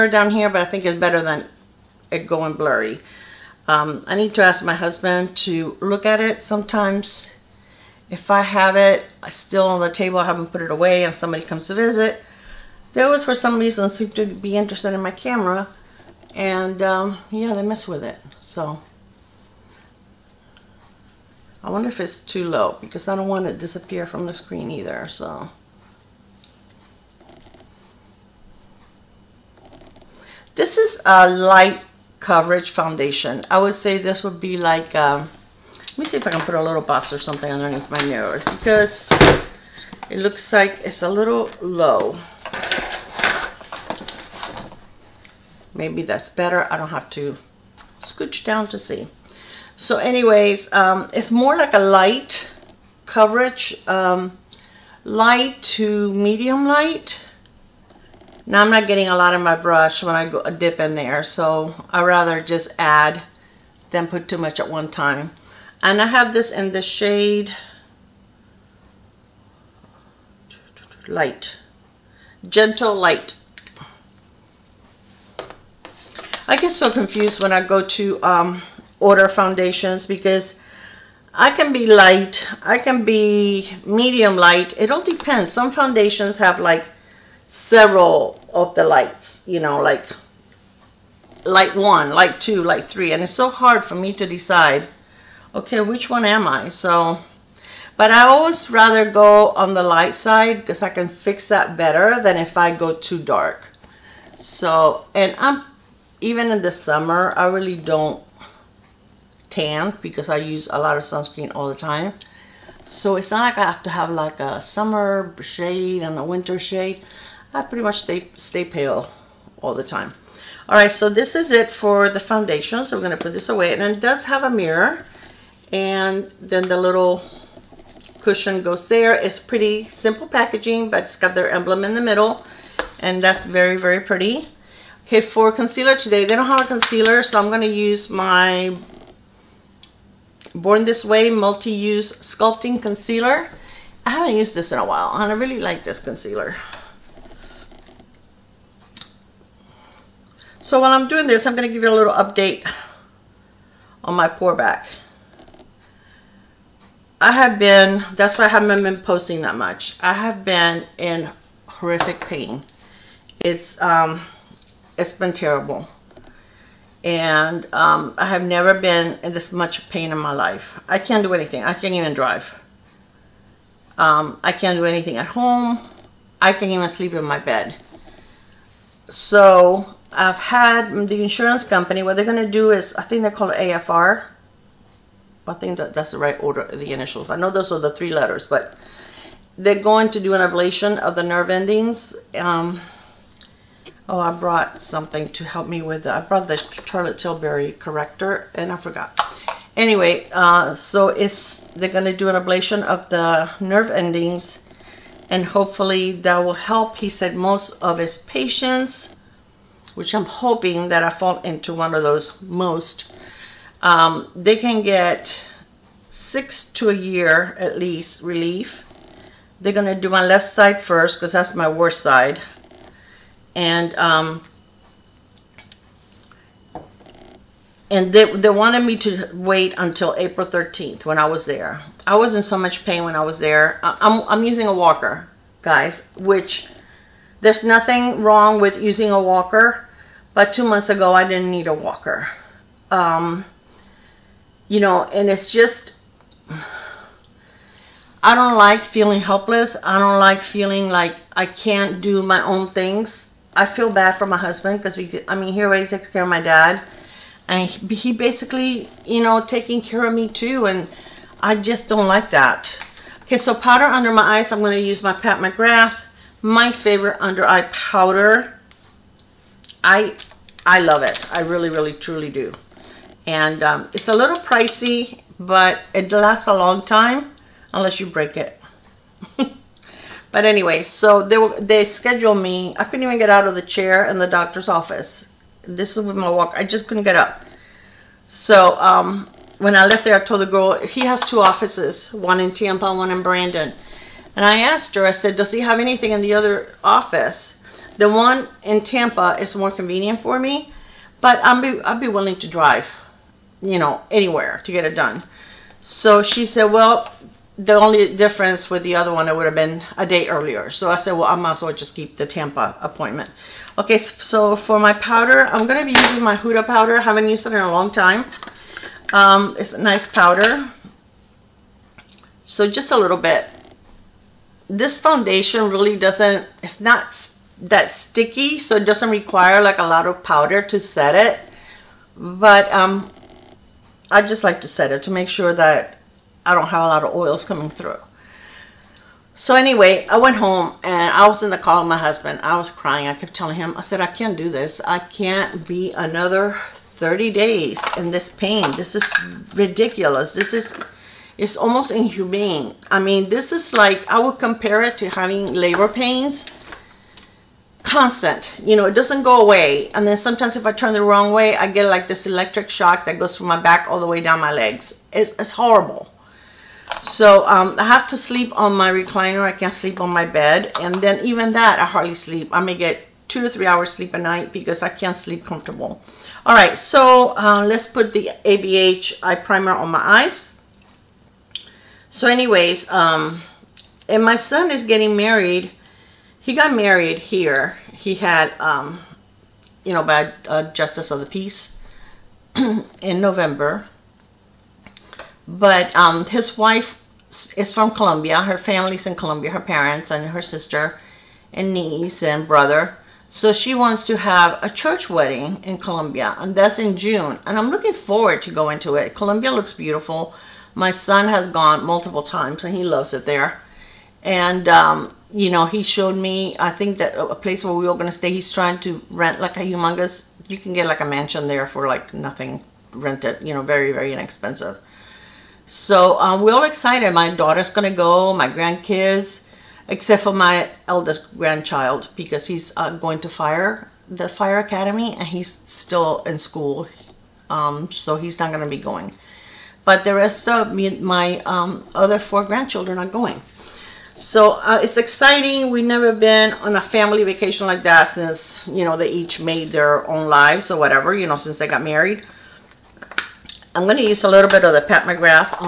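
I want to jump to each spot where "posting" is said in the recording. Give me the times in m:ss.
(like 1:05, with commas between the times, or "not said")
2:39.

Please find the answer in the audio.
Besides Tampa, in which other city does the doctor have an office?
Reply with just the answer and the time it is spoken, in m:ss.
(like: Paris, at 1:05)
Brandon, at 4:53.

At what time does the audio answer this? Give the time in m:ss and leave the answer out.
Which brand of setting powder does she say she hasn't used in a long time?
5:16.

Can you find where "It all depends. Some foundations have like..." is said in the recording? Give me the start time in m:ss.
1:24.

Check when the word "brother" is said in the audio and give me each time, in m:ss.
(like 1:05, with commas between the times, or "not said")
6:42.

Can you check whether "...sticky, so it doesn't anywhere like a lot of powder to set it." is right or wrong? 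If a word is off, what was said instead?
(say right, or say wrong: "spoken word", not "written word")
wrong: "require", not "anywhere".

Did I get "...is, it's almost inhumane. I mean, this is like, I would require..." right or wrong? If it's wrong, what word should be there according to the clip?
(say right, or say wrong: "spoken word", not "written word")
wrong: "compare", not "require".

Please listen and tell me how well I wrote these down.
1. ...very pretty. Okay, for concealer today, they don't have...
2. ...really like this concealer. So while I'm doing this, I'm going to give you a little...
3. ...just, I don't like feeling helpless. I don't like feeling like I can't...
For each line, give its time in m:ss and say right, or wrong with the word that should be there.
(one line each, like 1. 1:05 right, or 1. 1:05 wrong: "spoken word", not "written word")
1. 2:13 right
2. 2:25 right
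3. 4:05 right.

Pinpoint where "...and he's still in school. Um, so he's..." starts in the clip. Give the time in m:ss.
7:15.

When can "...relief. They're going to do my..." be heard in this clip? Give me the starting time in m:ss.
3:38.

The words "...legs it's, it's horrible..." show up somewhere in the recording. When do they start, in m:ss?
6:04.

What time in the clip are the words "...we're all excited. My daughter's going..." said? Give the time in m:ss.
7:06.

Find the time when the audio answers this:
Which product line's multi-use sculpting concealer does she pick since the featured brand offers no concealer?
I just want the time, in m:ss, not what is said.
2:20.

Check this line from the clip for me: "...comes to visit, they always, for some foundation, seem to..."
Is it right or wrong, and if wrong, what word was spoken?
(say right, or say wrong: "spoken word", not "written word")
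wrong: "reason", not "foundation".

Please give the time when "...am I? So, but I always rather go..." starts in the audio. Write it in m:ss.
1:36.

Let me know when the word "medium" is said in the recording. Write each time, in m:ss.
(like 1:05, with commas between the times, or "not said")
0:56, 1:23.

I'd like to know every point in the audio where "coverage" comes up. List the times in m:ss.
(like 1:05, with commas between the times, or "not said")
0:32, 0:53.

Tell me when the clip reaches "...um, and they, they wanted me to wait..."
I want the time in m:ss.
3:43.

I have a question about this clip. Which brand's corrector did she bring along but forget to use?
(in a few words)
Charlotte Tilbury.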